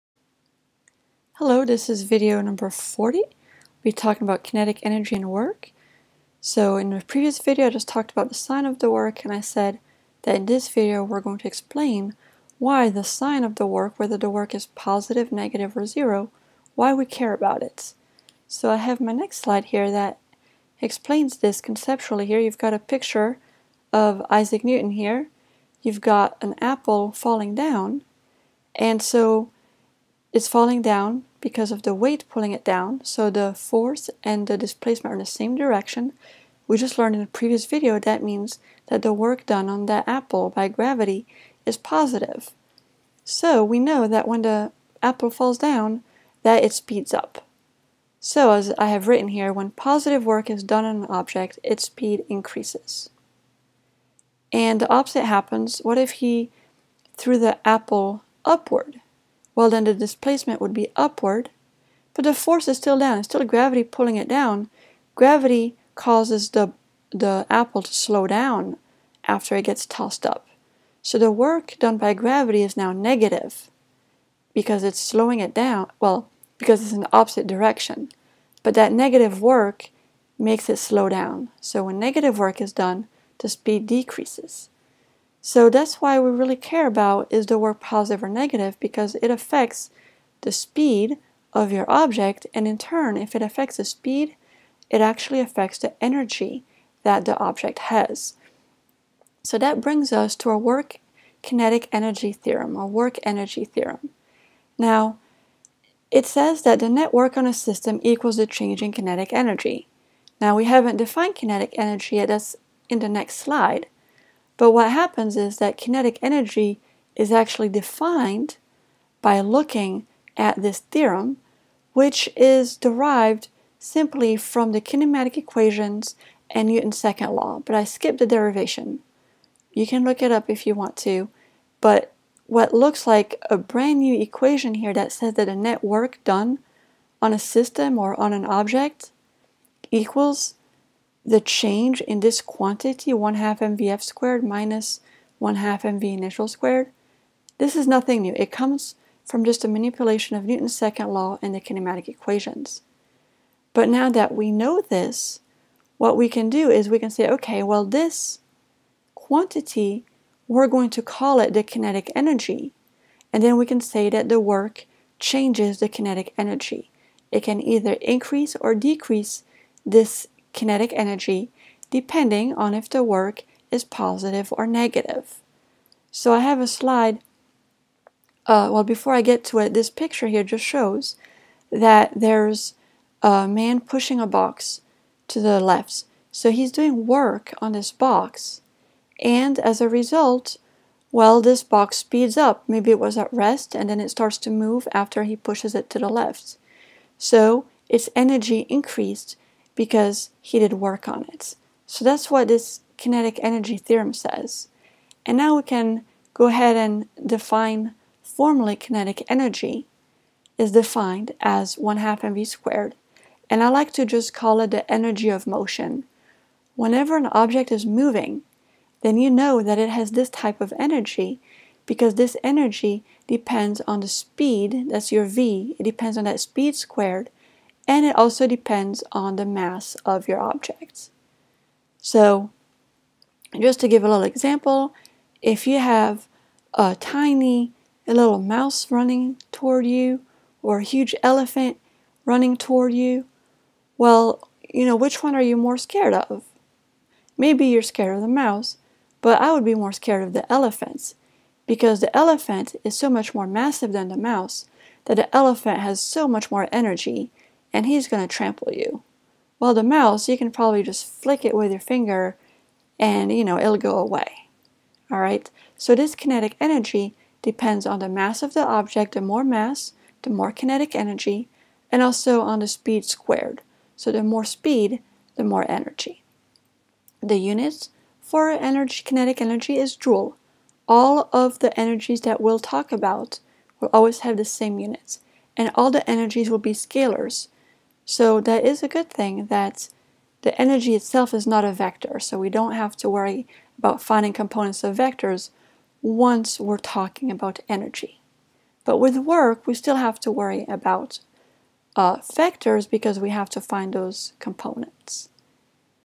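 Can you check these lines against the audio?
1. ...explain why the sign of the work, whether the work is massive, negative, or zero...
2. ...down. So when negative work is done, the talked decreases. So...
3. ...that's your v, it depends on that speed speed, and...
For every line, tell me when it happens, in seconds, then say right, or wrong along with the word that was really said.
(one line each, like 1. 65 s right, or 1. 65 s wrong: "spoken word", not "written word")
1. 11 s wrong: "positive", not "massive"
2. 81 s wrong: "speed", not "talked"
3. 224 s wrong: "squared", not "speed".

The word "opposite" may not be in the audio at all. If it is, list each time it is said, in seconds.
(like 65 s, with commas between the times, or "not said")
54 s, 77 s.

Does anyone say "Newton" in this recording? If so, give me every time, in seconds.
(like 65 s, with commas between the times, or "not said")
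24 s, 126 s, 150 s.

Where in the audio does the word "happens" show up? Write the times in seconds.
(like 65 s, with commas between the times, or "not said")
55 s, 114 s.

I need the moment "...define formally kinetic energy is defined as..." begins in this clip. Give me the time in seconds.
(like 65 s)
207 s.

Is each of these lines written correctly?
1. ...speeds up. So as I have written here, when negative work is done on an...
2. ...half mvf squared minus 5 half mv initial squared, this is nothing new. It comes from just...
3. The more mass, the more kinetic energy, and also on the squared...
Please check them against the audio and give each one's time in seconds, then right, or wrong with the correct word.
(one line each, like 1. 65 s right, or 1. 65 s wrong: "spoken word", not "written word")
1. 46 s wrong: "positive", not "negative"
2. 143 s wrong: "1", not "5"
3. 269 s wrong: "speed", not "squared".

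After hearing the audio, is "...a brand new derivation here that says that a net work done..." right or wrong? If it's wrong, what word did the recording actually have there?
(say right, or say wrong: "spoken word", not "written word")
wrong: "equation", not "derivation".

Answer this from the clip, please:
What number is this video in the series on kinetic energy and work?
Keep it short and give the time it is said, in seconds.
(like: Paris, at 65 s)
40, at 2 s.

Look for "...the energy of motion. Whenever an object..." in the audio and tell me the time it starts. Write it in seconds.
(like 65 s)
214 s.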